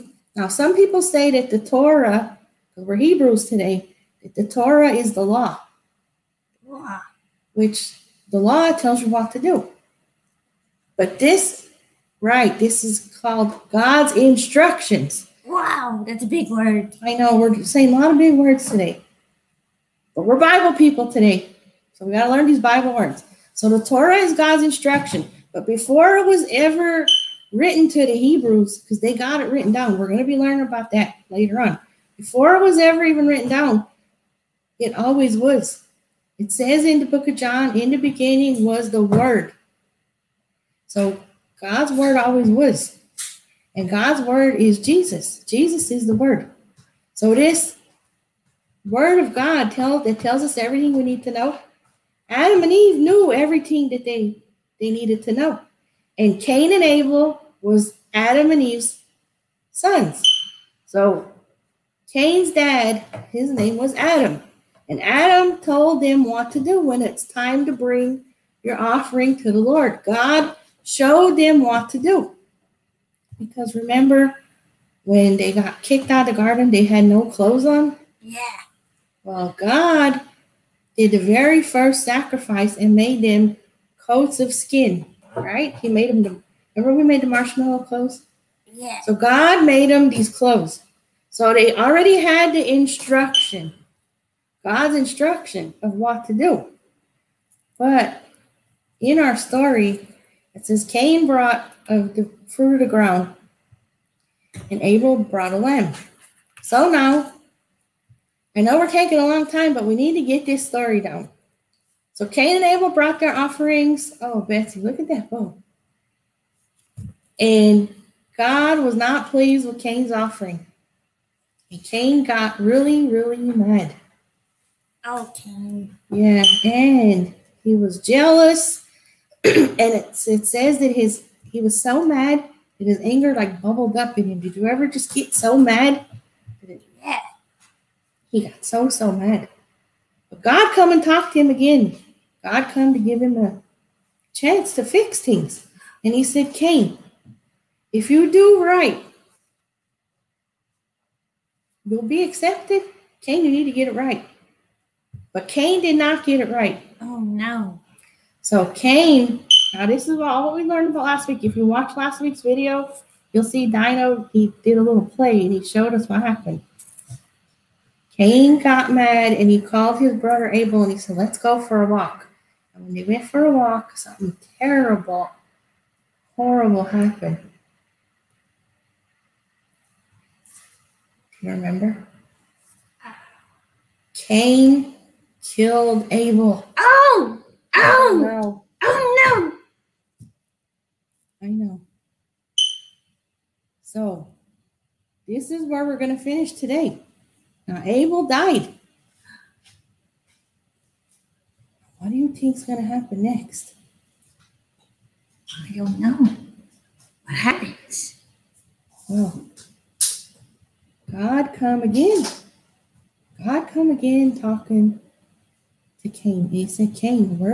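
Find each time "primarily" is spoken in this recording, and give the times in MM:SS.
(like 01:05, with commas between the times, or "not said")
not said.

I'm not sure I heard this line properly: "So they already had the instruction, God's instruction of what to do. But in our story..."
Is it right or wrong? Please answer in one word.
right.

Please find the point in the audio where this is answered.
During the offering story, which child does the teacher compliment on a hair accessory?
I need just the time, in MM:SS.
01:54.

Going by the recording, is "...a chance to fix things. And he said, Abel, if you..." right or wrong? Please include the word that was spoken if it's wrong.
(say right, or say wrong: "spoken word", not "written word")
wrong: "Cain", not "Abel".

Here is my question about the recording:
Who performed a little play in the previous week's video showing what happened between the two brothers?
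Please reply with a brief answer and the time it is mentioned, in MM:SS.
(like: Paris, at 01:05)
Dino, at 02:43.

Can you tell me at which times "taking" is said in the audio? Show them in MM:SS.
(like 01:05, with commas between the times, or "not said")
01:48.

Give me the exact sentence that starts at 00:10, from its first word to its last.
But this, right, this is called God's instructions.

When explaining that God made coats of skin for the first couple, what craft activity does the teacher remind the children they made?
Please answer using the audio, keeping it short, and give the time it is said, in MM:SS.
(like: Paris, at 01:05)
marshmallow clothes, at 01:27.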